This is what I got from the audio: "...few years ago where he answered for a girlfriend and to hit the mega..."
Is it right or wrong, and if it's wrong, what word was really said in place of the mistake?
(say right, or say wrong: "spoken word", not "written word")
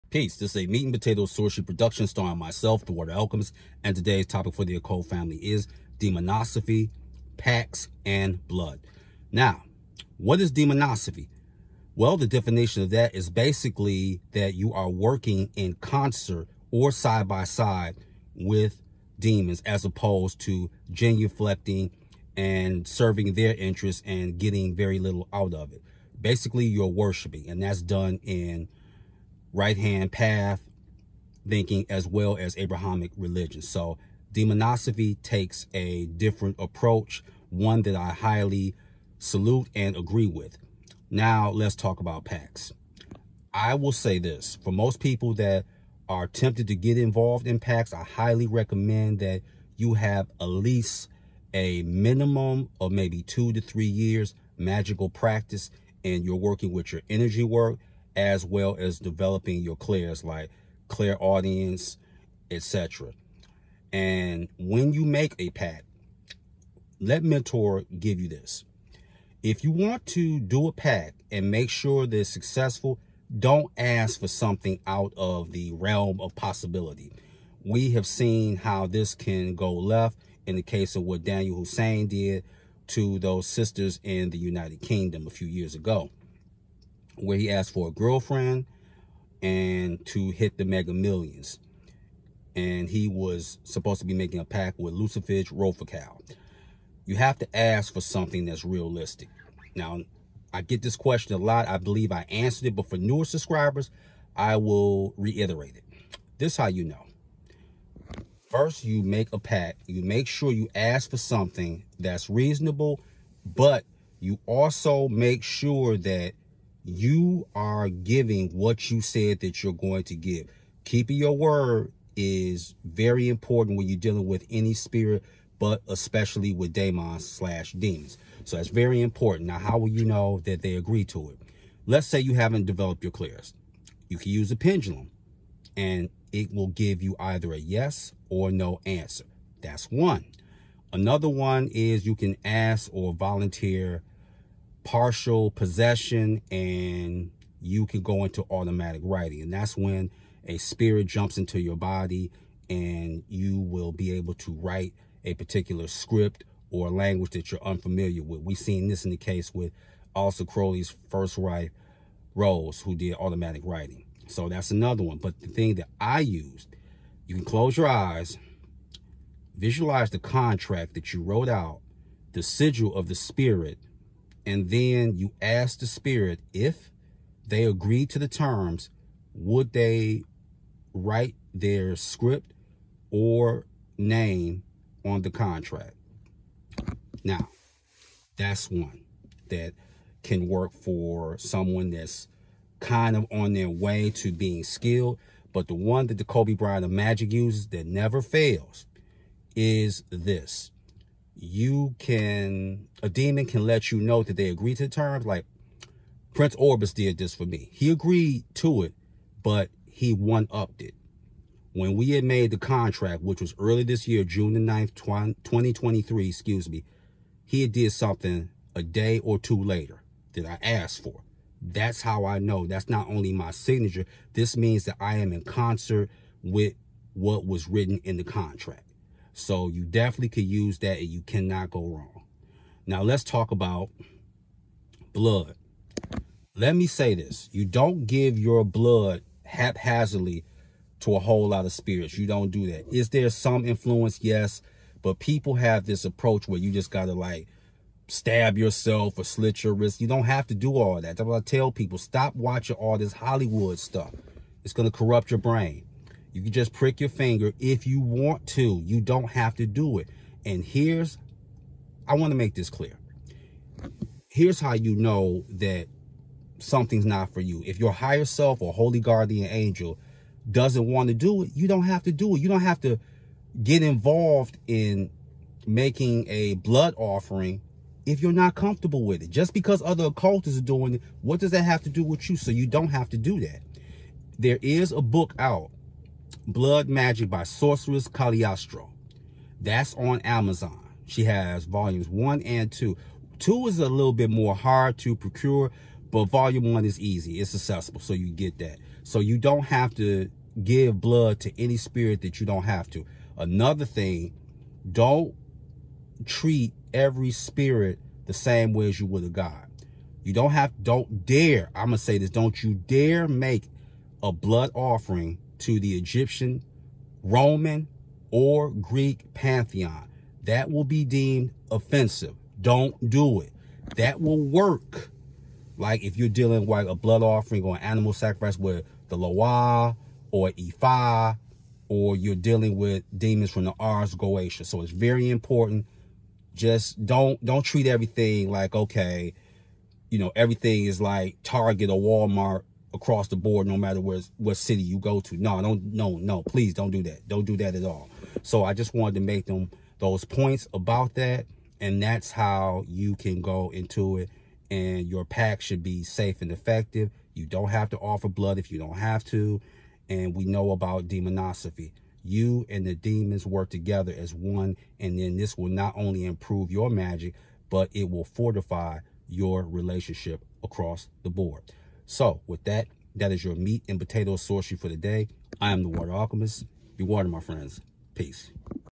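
wrong: "asked", not "answered".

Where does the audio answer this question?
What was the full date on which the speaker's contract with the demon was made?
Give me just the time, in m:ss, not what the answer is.
3:34.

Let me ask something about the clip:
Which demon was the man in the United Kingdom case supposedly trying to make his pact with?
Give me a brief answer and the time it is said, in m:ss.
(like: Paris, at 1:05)
Lucifuge Rofocale, at 1:34.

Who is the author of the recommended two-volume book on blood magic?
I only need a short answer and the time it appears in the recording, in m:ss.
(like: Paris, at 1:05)
Sorceress Cagliastro, at 4:47.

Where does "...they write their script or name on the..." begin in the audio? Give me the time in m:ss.
2:59.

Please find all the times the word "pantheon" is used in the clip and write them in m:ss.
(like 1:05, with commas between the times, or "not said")
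5:19.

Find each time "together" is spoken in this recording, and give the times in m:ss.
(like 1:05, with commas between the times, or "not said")
6:03.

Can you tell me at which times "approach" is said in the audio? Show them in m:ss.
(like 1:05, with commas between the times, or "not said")
0:36, 4:06.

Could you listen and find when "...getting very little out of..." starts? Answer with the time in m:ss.
0:24.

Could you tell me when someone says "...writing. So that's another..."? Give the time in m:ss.
2:43.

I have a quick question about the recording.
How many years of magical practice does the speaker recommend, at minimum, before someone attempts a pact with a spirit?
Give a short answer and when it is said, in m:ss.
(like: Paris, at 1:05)
2 to 3 years, at 0:53.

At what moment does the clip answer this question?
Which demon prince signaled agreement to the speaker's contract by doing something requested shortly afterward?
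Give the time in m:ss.
3:26.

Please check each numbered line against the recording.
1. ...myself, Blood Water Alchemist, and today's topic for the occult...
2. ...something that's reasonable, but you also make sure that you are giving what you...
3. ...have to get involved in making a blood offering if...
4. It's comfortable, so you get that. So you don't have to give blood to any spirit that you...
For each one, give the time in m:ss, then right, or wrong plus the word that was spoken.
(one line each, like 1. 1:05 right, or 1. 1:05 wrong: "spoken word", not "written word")
1. 0:02 wrong: "The", not "Blood"
2. 1:51 right
3. 4:32 right
4. 4:57 wrong: "accessible", not "comfortable".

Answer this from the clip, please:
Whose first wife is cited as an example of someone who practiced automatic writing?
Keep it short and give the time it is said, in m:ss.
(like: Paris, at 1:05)
Crowley, at 2:40.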